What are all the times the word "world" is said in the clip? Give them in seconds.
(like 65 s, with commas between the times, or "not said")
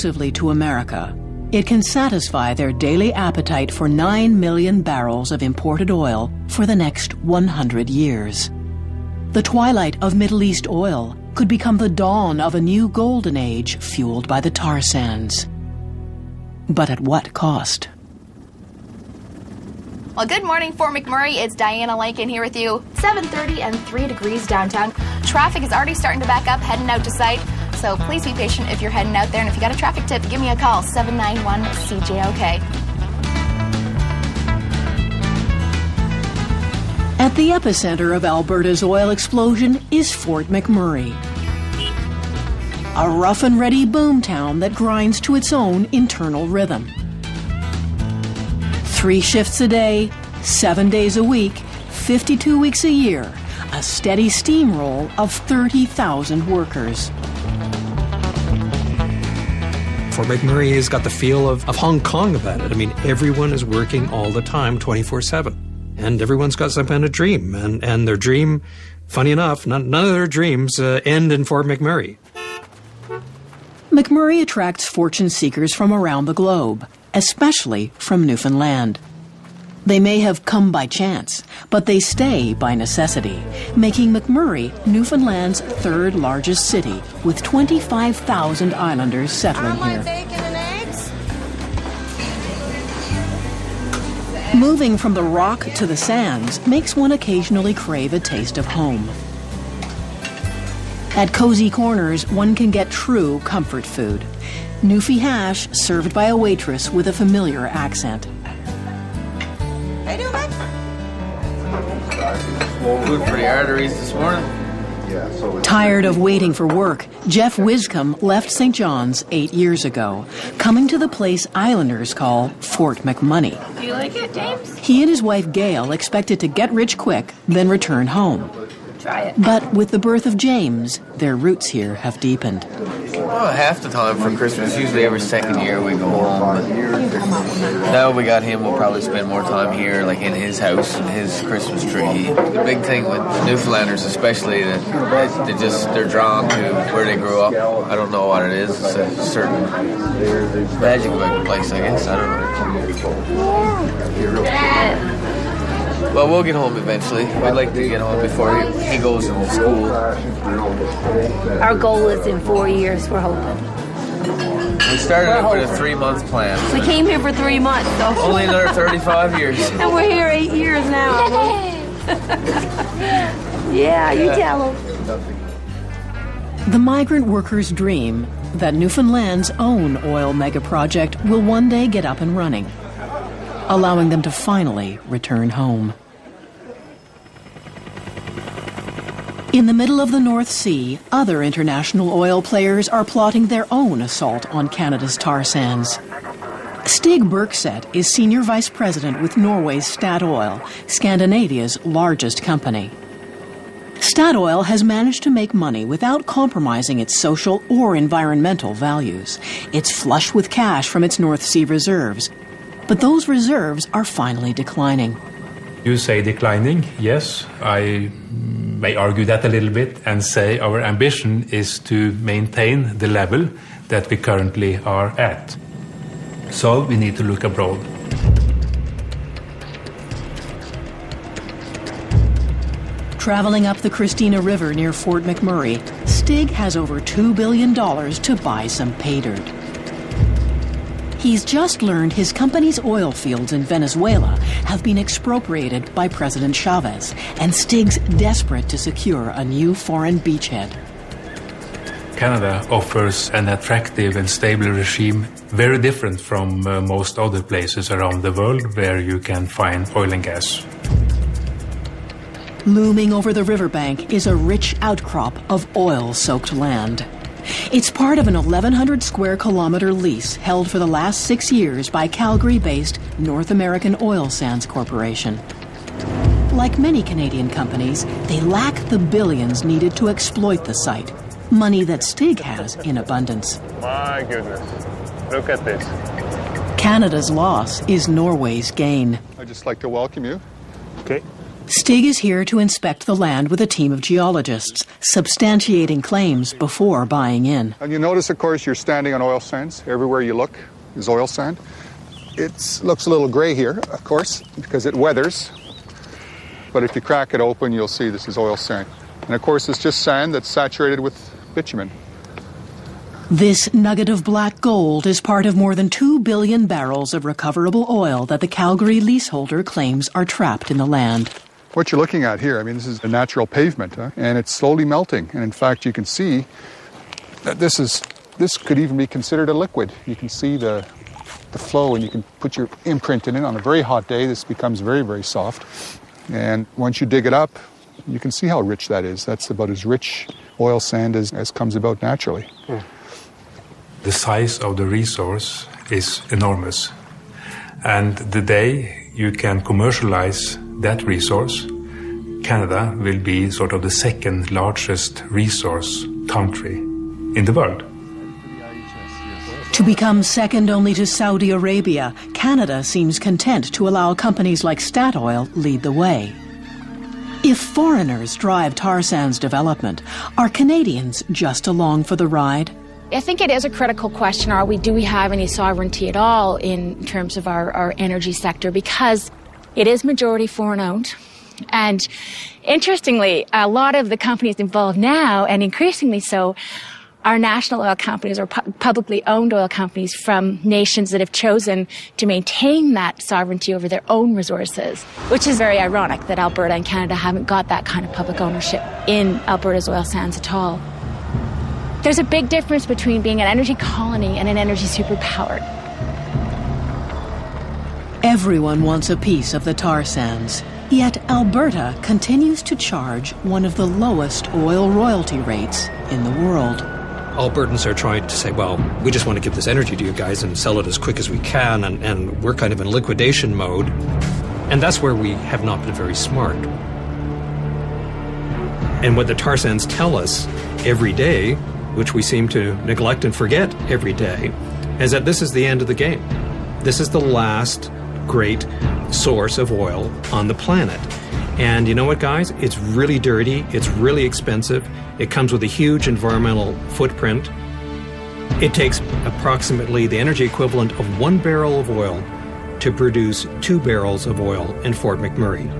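258 s, 357 s, 416 s.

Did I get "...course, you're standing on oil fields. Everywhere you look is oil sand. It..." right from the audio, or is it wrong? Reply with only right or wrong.
wrong.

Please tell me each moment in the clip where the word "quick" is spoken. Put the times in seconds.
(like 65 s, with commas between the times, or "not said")
126 s, 420 s.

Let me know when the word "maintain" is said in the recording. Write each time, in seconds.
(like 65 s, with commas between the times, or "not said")
222 s, 392 s.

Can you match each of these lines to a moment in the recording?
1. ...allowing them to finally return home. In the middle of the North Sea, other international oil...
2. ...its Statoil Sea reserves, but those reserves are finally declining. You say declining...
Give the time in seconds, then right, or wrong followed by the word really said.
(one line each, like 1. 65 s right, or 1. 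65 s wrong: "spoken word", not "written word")
1. 183 s right
2. 211 s wrong: "North", not "Statoil".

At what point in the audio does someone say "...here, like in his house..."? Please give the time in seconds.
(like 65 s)
139 s.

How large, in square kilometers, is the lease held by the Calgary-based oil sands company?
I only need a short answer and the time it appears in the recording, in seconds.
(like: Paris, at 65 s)
1,100 square kilometers, at 268 s.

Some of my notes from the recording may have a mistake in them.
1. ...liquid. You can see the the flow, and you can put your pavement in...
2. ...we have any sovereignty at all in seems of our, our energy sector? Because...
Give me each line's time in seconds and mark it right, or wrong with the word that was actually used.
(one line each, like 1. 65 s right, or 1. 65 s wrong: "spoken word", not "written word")
1. 329 s wrong: "imprint", not "pavement"
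2. 374 s wrong: "terms", not "seems".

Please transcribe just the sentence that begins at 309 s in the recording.
And of course, it's just sand that's saturated with bitumen.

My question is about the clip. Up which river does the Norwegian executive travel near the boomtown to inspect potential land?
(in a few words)
Christina River.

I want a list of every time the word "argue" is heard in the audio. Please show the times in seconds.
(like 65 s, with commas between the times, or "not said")
218 s.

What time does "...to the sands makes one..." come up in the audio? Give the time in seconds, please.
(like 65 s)
95 s.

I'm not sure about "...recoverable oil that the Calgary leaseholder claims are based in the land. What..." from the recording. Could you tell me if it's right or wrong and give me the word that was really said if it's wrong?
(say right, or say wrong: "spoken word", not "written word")
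wrong: "trapped", not "based".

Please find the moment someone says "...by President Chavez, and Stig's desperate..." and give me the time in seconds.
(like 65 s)
245 s.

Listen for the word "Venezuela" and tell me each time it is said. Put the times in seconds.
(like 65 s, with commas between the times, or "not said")
243 s.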